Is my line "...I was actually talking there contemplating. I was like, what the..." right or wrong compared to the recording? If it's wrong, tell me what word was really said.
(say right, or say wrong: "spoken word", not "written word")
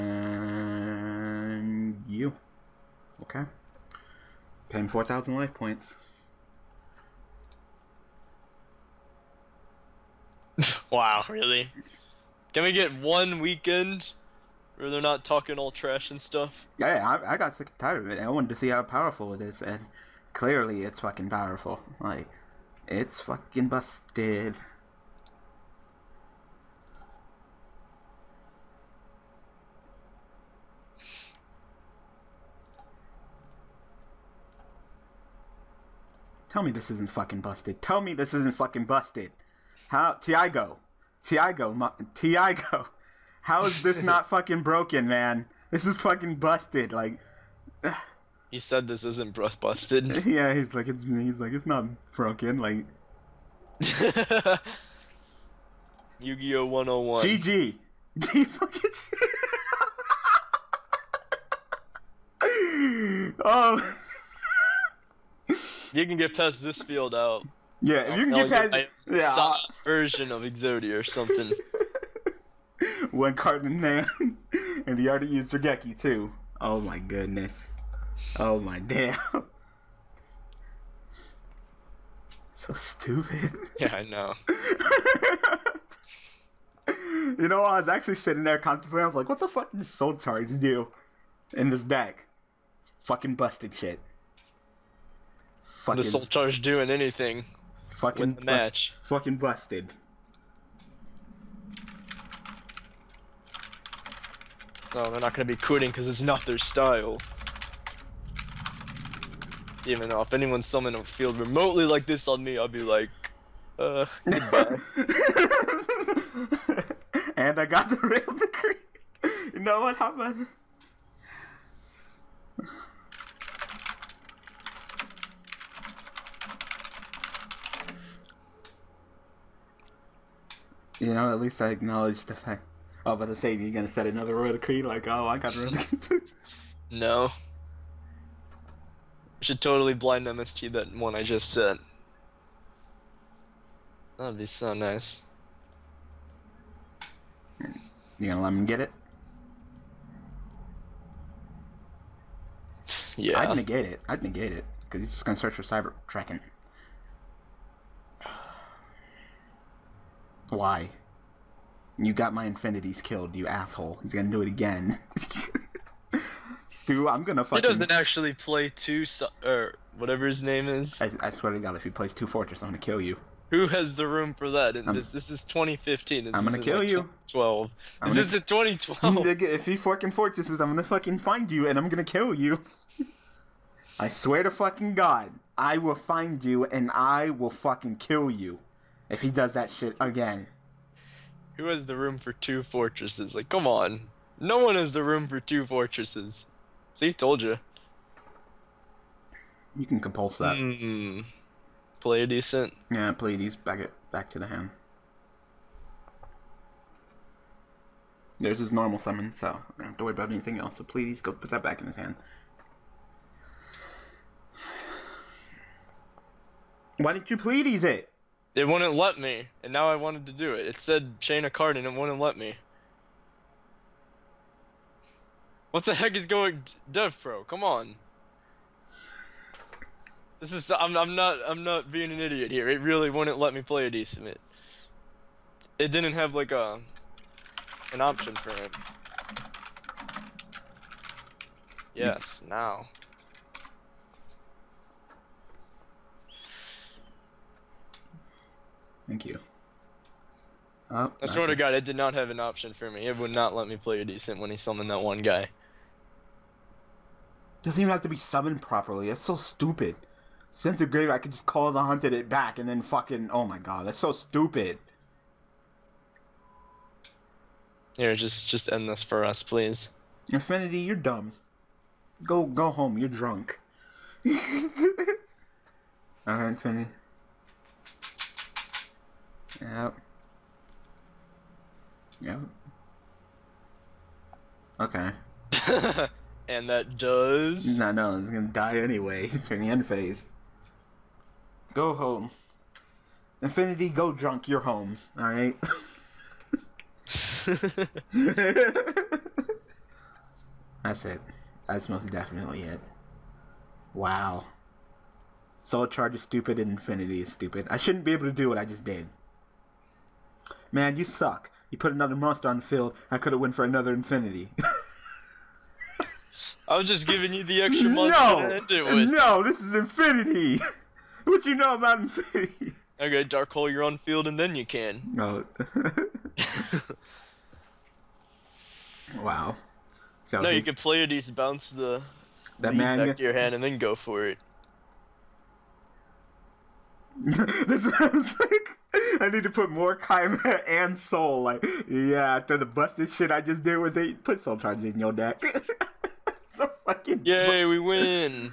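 wrong: "sitting", not "talking".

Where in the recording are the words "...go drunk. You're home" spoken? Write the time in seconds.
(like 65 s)
293 s.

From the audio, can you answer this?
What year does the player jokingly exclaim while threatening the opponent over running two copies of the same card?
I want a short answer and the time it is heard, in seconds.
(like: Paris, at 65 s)
2012, at 178 s.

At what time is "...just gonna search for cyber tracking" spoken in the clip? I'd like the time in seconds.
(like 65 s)
155 s.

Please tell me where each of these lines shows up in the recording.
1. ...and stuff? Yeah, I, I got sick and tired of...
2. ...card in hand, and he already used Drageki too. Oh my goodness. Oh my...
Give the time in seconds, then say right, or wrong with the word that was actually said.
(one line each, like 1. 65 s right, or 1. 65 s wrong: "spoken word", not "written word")
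1. 16 s right
2. 73 s right.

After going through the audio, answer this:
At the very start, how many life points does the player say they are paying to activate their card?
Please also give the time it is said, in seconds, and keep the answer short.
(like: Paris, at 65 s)
4,000, at 4 s.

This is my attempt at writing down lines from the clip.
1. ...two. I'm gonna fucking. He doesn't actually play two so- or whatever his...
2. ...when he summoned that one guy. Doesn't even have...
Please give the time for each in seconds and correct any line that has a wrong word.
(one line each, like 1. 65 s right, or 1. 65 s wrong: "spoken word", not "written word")
1. 166 s right
2. 254 s right.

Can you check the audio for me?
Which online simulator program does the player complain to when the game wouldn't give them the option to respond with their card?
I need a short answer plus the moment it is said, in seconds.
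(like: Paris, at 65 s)
DevPro, at 226 s.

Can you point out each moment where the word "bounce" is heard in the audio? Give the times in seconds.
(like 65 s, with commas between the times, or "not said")
331 s.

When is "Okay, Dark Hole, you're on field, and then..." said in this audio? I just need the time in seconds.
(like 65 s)
323 s.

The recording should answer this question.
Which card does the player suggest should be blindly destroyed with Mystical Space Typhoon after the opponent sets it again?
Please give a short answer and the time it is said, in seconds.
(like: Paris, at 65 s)
Royal Decree, at 134 s.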